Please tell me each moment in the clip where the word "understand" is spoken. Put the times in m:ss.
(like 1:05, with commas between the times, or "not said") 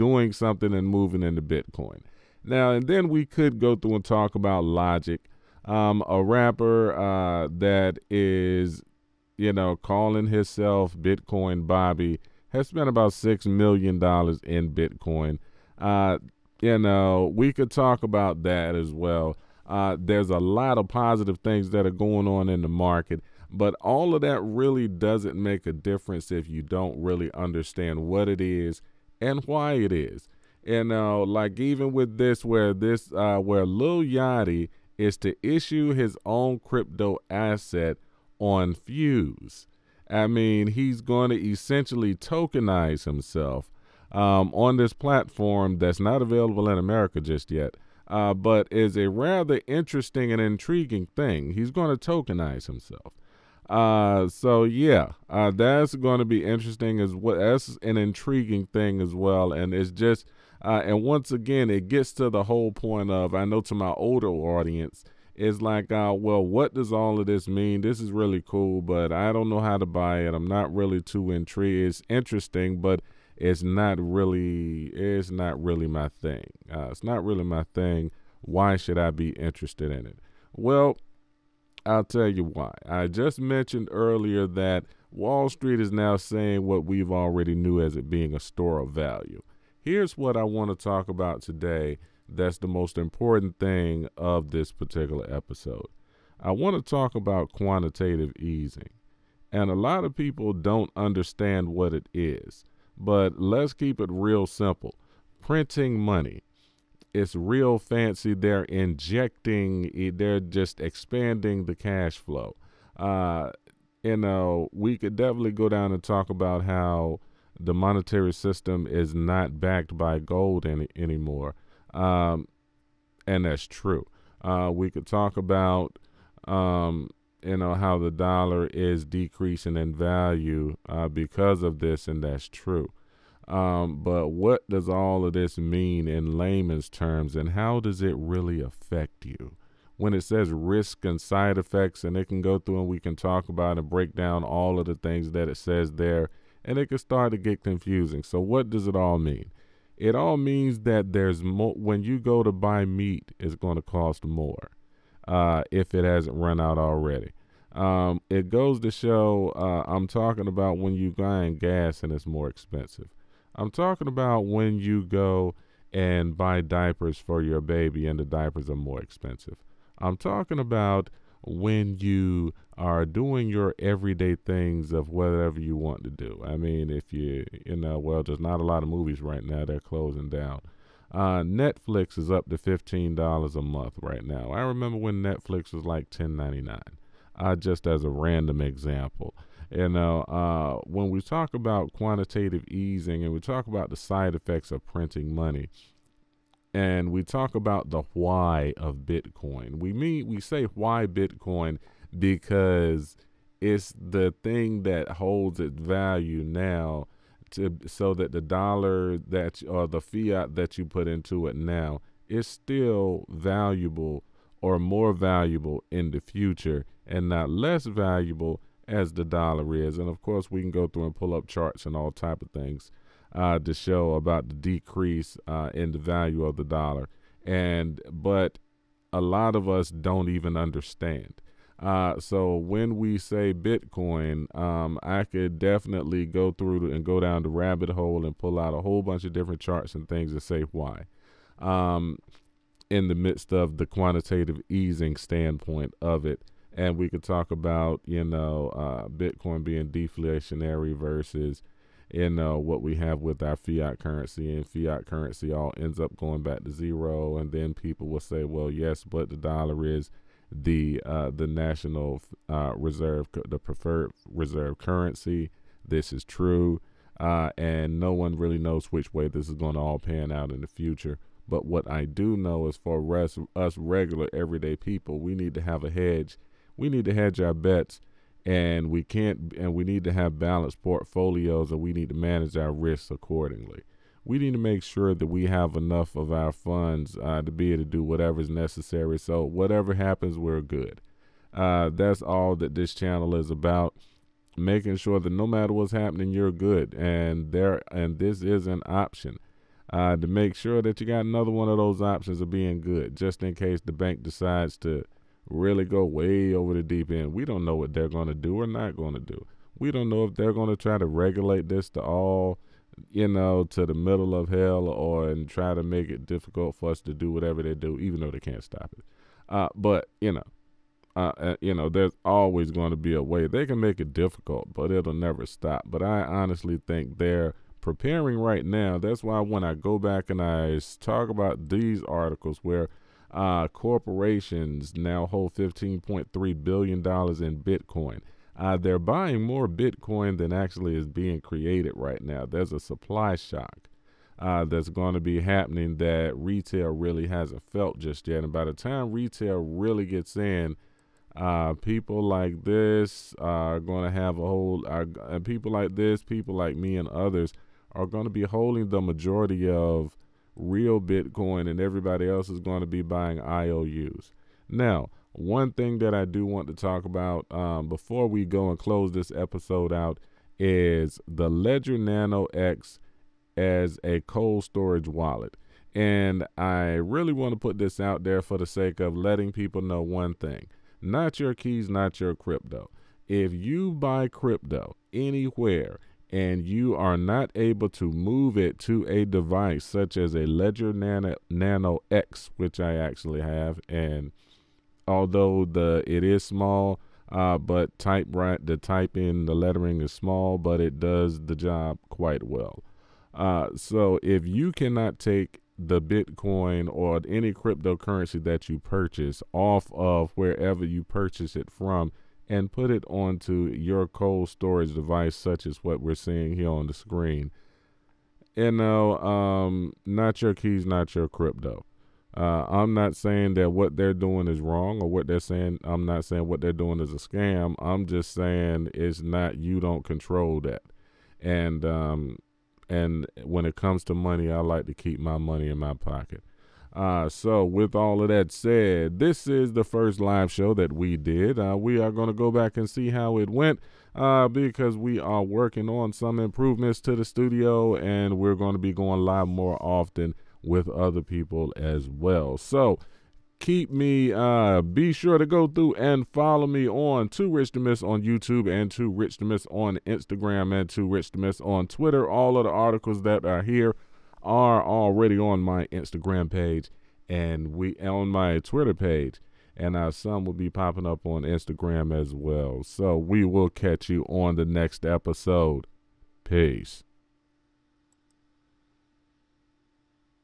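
0:27, 1:40, 3:50.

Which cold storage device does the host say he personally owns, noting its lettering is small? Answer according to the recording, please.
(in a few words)
Ledger Nano X.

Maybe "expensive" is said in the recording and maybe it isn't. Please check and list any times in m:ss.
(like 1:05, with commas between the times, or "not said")
2:42, 2:49.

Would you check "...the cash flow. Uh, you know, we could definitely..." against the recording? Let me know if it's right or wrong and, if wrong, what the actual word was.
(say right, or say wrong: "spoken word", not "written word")
right.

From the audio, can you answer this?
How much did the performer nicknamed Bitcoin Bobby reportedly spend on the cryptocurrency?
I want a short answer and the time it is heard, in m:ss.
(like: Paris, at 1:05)
$6 million, at 0:13.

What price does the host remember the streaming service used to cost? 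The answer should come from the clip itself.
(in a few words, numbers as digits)
$10.99.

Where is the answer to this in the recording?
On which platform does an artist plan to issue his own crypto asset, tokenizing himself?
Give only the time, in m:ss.
0:38.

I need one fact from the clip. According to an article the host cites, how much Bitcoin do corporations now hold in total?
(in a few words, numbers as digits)
$15.3 billion.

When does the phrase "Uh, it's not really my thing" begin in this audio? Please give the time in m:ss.
1:16.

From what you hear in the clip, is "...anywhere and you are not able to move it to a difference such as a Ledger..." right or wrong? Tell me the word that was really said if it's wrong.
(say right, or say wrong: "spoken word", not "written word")
wrong: "device", not "difference".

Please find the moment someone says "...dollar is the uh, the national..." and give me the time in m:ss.
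4:19.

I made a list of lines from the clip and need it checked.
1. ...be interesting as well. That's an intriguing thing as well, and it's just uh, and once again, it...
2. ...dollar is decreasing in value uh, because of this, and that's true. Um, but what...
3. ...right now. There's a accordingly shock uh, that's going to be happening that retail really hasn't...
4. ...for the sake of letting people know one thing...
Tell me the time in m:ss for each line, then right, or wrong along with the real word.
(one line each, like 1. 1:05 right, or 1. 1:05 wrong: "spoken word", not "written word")
1. 0:56 right
2. 2:08 right
3. 5:41 wrong: "supply", not "accordingly"
4. 6:18 right.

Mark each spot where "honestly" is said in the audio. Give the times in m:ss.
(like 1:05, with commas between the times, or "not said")
5:26.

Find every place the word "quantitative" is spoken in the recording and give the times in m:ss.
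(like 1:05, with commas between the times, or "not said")
1:37, 3:11, 4:03.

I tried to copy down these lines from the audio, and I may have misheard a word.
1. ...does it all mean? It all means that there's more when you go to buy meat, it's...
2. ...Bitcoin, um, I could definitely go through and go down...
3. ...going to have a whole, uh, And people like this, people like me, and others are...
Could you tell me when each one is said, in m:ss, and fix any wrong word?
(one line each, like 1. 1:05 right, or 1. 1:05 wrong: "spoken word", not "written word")
1. 2:28 right
2. 3:53 right
3. 5:53 right.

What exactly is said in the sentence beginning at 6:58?
You know, um, not your keys, not your crypto.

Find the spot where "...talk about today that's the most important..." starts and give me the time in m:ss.
1:30.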